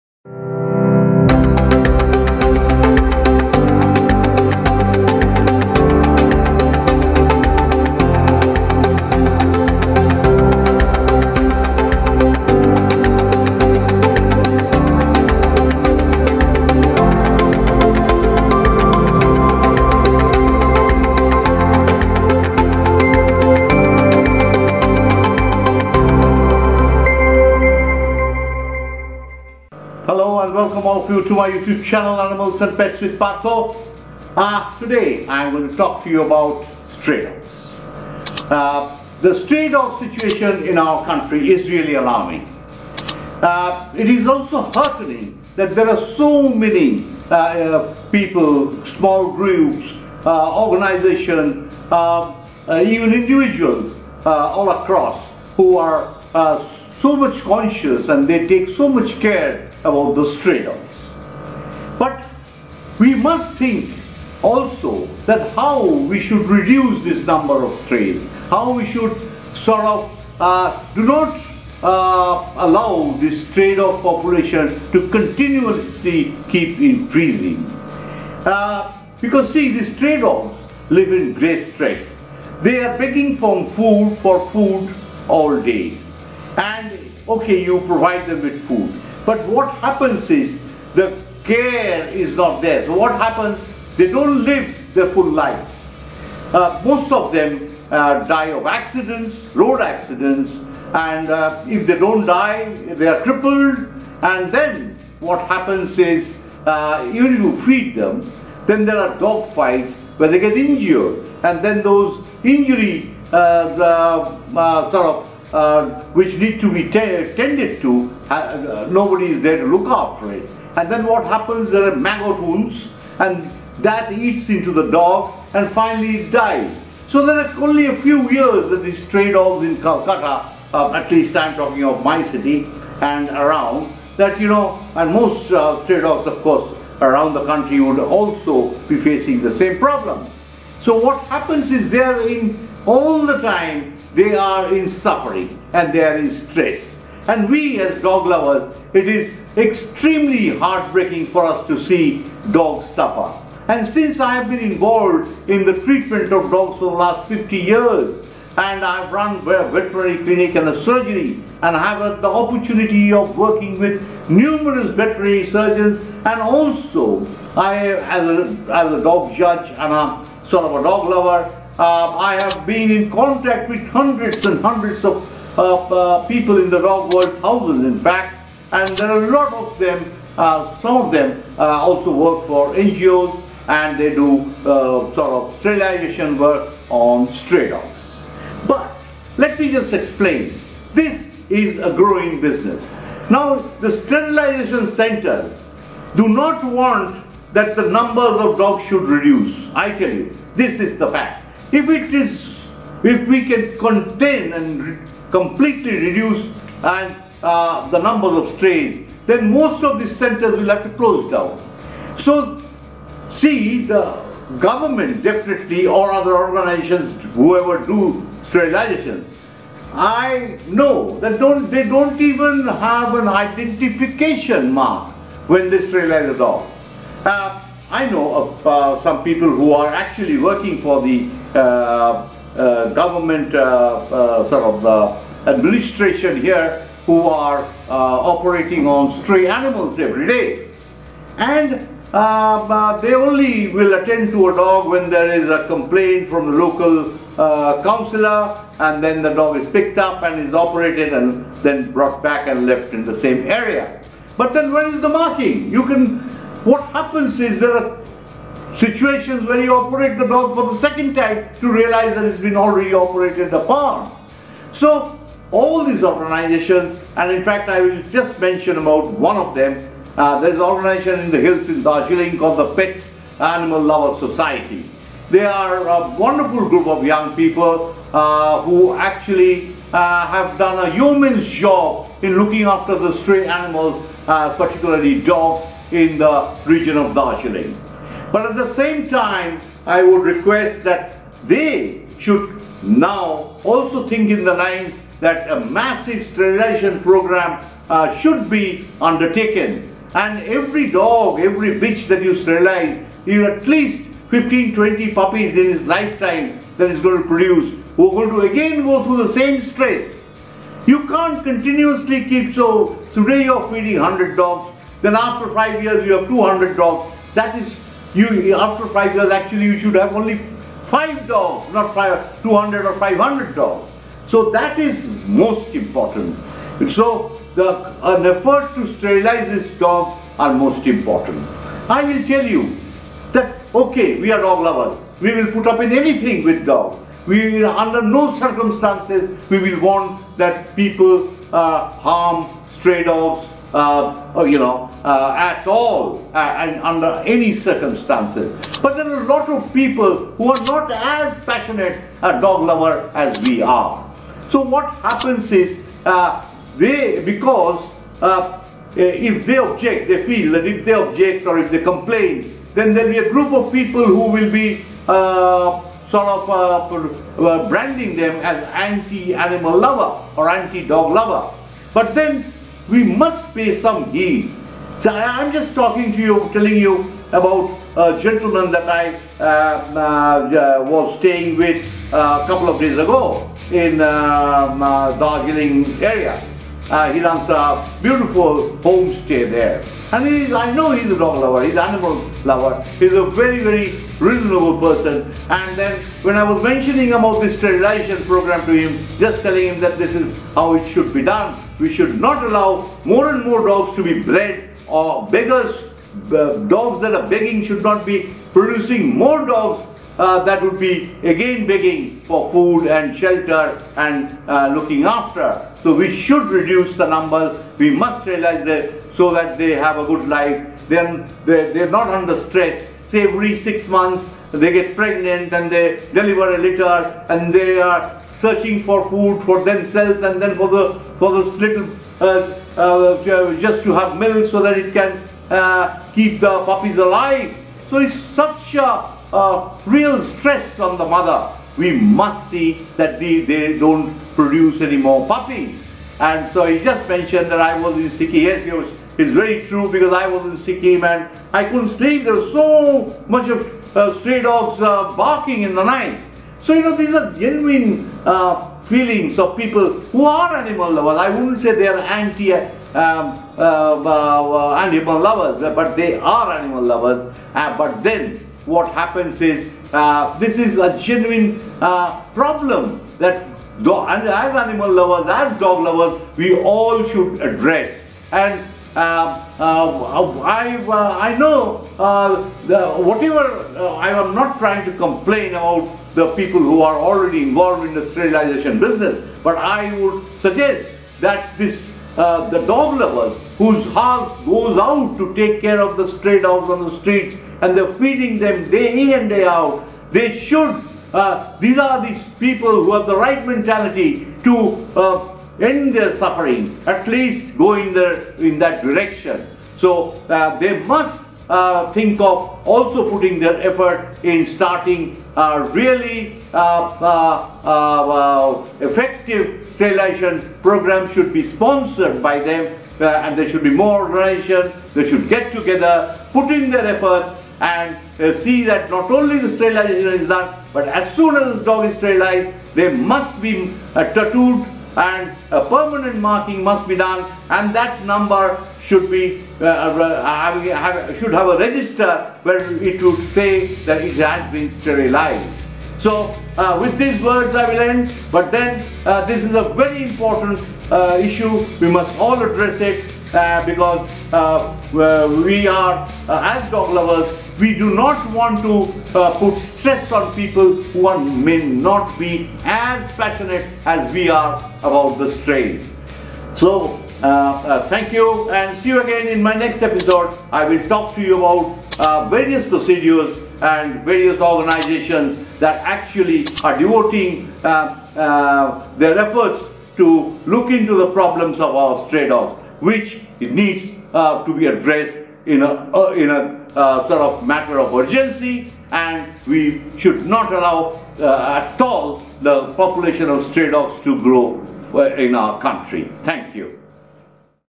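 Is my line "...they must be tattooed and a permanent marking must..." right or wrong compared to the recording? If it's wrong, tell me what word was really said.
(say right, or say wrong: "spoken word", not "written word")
right.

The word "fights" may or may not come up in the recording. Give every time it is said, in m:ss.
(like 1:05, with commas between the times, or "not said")
1:49.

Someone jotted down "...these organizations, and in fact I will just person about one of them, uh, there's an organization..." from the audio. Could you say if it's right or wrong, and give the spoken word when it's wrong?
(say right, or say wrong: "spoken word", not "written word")
wrong: "mention", not "person".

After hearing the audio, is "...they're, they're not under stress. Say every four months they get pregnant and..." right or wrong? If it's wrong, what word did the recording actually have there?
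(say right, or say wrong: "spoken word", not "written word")
wrong: "six", not "four".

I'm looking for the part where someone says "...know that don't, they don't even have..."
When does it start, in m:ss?
3:40.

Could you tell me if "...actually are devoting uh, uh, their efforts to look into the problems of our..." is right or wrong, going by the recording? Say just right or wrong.
right.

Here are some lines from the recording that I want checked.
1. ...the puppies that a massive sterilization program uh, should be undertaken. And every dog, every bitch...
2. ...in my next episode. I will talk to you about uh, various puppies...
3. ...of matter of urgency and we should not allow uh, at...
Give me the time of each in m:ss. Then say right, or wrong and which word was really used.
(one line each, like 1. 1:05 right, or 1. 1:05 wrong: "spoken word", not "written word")
1. 4:54 wrong: "lines", not "puppies"
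2. 9:29 wrong: "procedures", not "puppies"
3. 9:47 right.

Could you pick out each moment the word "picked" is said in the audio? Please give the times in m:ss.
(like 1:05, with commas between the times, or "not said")
4:09.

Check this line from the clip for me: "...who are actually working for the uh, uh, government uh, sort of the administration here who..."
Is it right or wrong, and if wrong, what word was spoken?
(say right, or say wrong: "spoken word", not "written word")
right.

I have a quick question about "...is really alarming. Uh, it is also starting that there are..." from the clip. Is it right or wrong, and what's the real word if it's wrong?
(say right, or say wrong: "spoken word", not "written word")
wrong: "heartening", not "starting".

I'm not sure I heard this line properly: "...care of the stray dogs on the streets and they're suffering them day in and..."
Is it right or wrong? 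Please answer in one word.
wrong.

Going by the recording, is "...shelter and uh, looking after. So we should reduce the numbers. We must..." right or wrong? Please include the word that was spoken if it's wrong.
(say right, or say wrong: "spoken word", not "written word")
right.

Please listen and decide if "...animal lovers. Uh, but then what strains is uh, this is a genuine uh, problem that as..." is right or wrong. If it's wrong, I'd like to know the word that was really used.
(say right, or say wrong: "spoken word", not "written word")
wrong: "happens", not "strains".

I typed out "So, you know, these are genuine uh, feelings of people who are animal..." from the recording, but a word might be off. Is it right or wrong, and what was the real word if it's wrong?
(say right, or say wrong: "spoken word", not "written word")
right.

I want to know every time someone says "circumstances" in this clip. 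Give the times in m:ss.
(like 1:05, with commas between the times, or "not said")
5:38, 5:47.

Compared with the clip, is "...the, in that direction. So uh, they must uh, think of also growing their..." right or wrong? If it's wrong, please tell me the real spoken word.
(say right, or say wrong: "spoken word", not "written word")
wrong: "putting", not "growing".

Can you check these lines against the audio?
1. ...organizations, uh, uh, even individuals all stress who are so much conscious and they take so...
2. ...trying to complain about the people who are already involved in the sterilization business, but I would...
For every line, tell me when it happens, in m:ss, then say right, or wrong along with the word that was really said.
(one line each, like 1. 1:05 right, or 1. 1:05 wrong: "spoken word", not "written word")
1. 0:50 wrong: "across", not "stress"
2. 8:04 right.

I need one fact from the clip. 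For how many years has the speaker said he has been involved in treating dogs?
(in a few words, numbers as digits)
50.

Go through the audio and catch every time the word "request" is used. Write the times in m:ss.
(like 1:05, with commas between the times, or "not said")
4:50.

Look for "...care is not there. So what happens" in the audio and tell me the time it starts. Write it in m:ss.
1:31.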